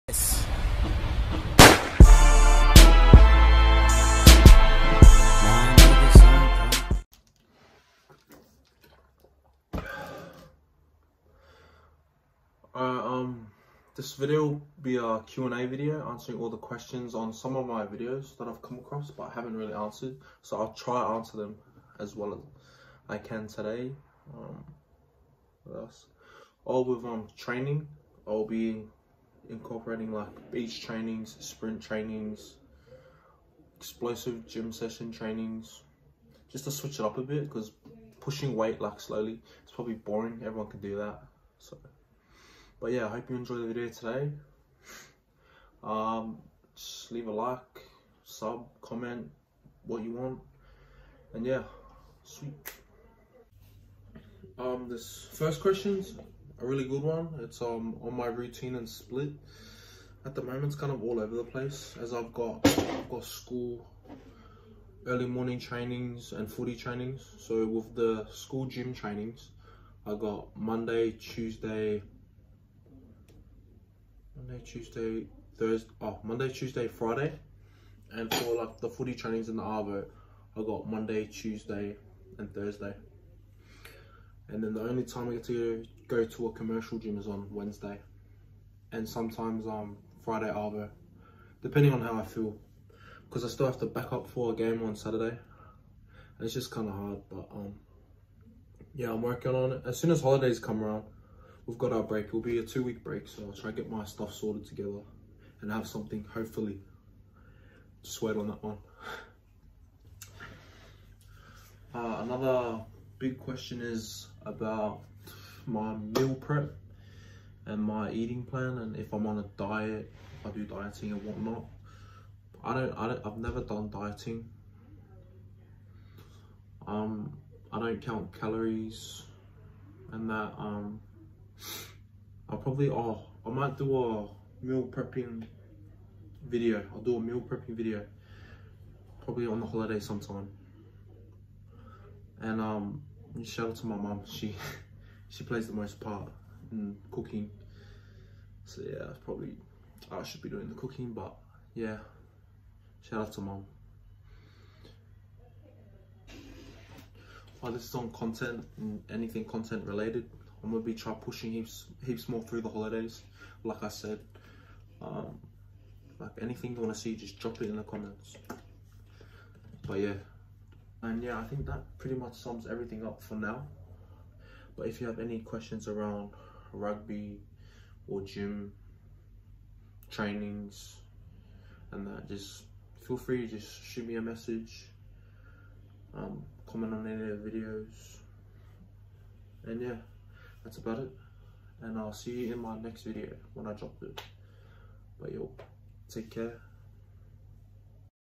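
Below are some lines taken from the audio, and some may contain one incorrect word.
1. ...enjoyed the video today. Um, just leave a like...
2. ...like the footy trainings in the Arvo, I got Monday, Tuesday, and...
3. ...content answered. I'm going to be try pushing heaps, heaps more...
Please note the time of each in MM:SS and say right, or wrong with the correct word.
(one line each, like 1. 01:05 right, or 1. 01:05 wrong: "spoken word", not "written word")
1. 00:43 right
2. 01:18 right
3. 02:39 wrong: "related", not "answered".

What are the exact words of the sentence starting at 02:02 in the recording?
I don't, I don't, I've never done dieting.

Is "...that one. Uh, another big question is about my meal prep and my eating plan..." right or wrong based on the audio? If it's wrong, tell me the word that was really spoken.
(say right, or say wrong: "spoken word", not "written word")
right.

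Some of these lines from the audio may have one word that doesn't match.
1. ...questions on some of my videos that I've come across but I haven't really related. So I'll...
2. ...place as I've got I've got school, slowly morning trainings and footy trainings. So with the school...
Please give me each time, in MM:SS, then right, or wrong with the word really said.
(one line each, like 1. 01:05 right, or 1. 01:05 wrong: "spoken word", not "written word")
1. 00:16 wrong: "answered", not "related"
2. 01:01 wrong: "early", not "slowly".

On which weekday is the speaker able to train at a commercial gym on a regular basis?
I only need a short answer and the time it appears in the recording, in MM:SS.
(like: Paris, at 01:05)
Wednesday, at 01:27.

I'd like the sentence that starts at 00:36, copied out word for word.
Just to switch it up a bit because pushing weight like slowly, it's probably boring.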